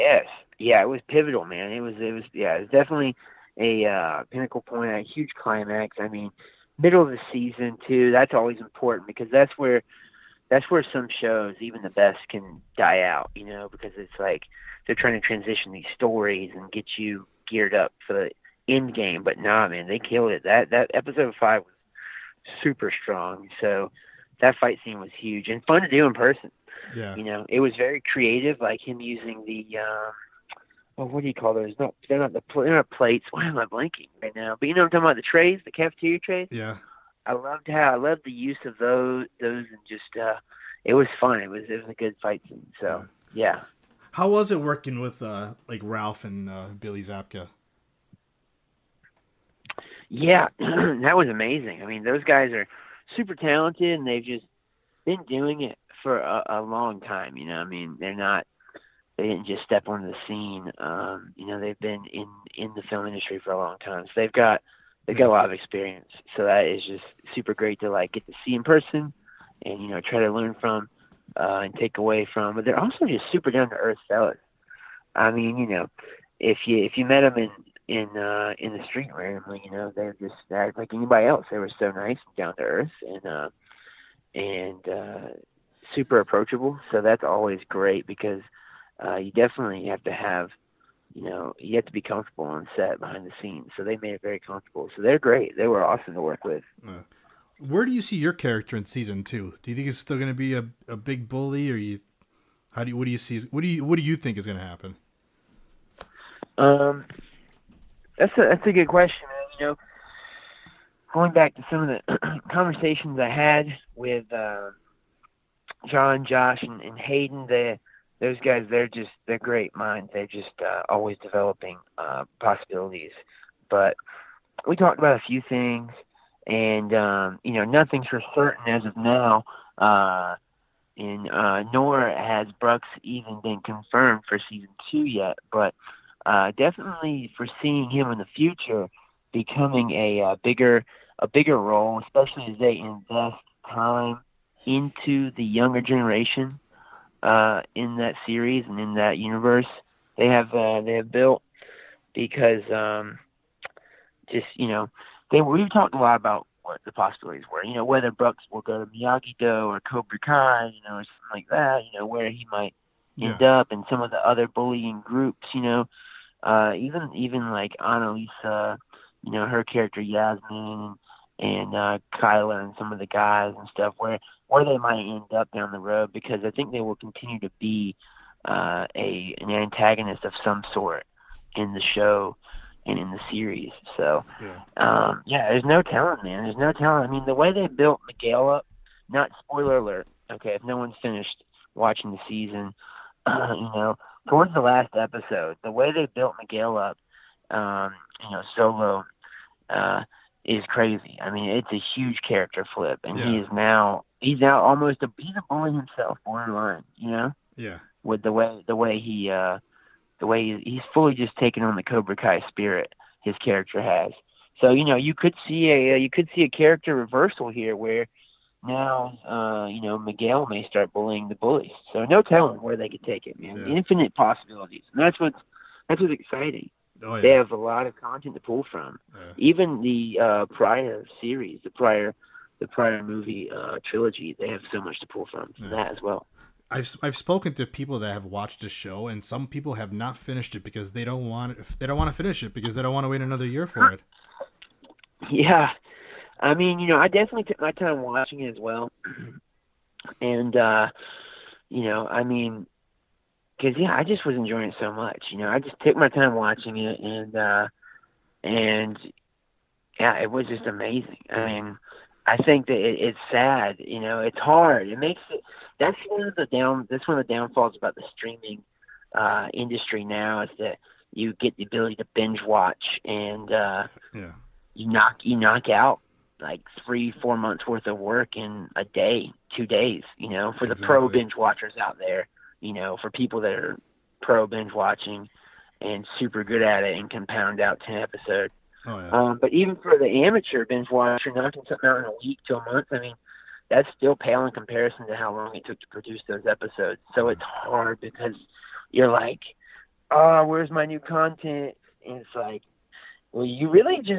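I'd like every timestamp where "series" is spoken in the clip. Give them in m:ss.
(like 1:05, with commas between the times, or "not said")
2:28, 3:03, 3:51.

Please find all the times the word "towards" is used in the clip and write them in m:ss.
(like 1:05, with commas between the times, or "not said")
3:14.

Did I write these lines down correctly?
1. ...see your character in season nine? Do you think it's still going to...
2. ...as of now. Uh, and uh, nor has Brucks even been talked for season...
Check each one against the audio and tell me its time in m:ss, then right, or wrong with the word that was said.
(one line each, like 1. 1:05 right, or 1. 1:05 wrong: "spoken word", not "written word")
1. 1:38 wrong: "two", not "nine"
2. 2:08 wrong: "confirmed", not "talked".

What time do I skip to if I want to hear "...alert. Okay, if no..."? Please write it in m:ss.
3:09.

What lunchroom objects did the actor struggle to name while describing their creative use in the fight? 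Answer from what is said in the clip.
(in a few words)
cafeteria trays.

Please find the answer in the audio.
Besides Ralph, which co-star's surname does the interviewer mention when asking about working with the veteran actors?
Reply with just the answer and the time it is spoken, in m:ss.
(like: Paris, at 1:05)
Zapka, at 0:47.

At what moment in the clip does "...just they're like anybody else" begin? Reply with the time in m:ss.
1:20.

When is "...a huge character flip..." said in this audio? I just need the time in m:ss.
3:21.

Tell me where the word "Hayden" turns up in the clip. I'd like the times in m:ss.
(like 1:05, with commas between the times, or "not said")
1:56.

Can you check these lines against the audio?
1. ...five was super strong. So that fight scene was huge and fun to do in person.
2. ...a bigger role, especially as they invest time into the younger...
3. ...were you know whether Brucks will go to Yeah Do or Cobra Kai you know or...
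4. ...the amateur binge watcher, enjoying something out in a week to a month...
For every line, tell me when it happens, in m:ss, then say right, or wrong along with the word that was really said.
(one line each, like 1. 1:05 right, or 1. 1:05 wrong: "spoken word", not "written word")
1. 0:21 right
2. 2:21 right
3. 2:37 wrong: "Miyagi", not "Yeah"
4. 4:49 wrong: "knocking", not "enjoying".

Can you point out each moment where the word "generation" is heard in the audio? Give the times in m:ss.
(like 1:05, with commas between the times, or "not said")
2:25.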